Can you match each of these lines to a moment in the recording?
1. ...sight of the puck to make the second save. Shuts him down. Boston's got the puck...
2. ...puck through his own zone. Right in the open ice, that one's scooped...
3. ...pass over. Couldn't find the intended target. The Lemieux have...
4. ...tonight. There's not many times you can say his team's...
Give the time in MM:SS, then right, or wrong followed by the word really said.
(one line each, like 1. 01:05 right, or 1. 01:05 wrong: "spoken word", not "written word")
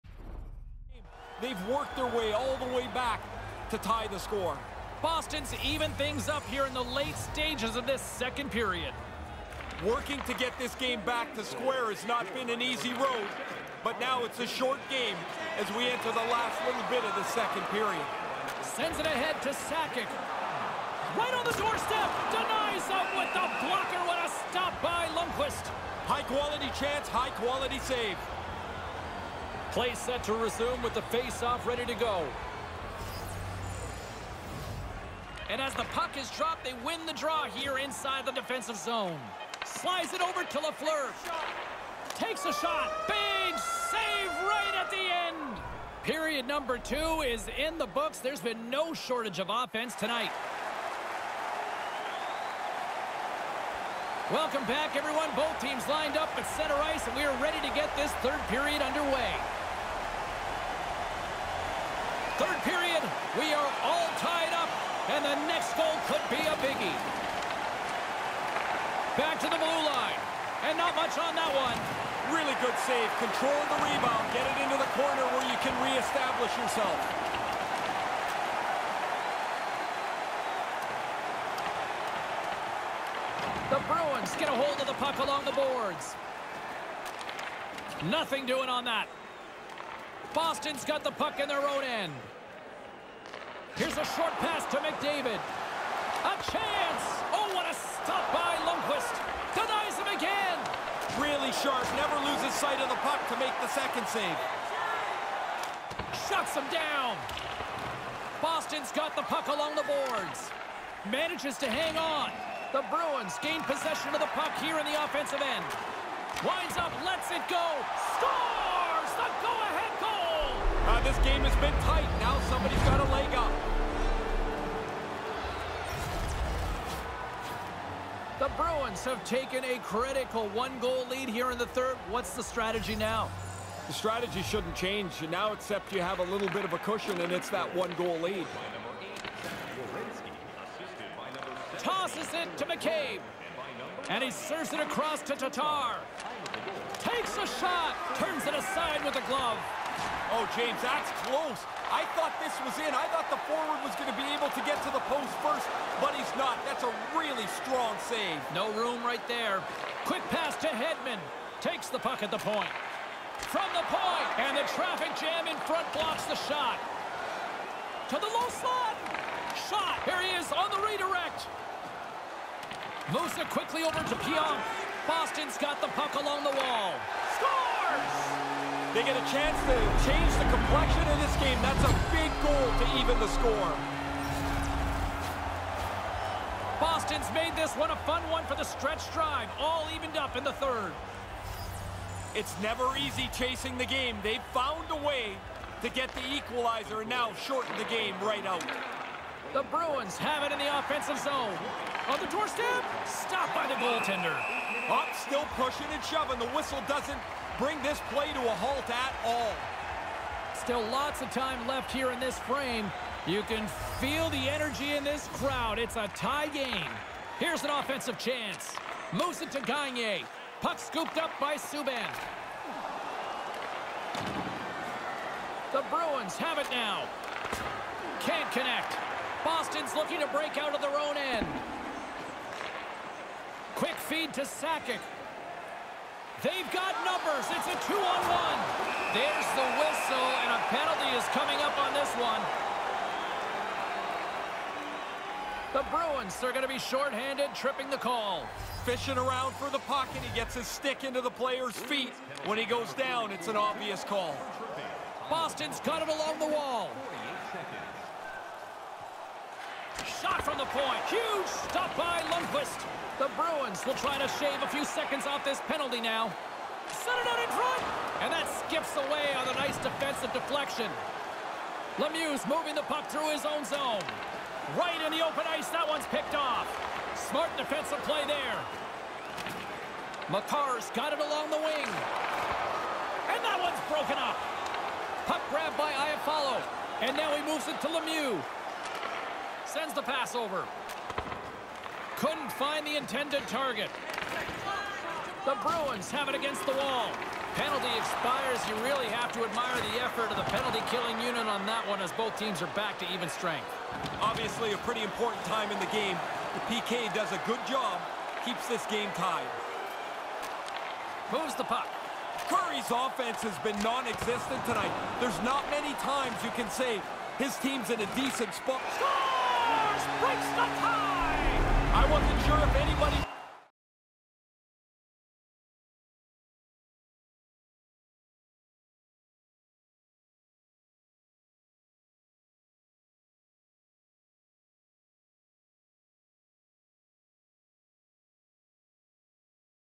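1. 01:42 right
2. 04:32 wrong: "picked", not "scooped"
3. 04:50 wrong: "Bruins", not "Lemieux"
4. 05:14 right.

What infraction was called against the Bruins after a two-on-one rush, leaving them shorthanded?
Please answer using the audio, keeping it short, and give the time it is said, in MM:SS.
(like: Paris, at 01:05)
Tripping, at 04:07.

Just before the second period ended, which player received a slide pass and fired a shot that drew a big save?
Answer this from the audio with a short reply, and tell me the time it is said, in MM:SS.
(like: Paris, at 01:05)
Lafleur, at 00:40.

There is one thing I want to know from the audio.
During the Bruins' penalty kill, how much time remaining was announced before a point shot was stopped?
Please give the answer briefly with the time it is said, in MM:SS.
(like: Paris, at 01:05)
48 seconds, at 04:17.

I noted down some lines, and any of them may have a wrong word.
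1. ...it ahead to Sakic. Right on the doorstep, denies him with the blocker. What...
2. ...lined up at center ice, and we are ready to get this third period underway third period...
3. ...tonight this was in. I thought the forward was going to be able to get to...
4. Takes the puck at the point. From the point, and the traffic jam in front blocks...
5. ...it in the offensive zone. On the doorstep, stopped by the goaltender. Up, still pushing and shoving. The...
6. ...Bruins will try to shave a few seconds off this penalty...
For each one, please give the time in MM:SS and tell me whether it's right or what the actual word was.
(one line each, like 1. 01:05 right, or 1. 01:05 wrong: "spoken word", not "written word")
1. 00:18 right
2. 00:55 right
3. 02:32 wrong: "thought", not "tonight"
4. 02:41 right
5. 03:20 right
6. 04:23 right.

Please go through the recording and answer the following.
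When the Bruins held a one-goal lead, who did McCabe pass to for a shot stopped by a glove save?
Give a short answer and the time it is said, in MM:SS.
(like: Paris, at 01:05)
Tatar, at 02:25.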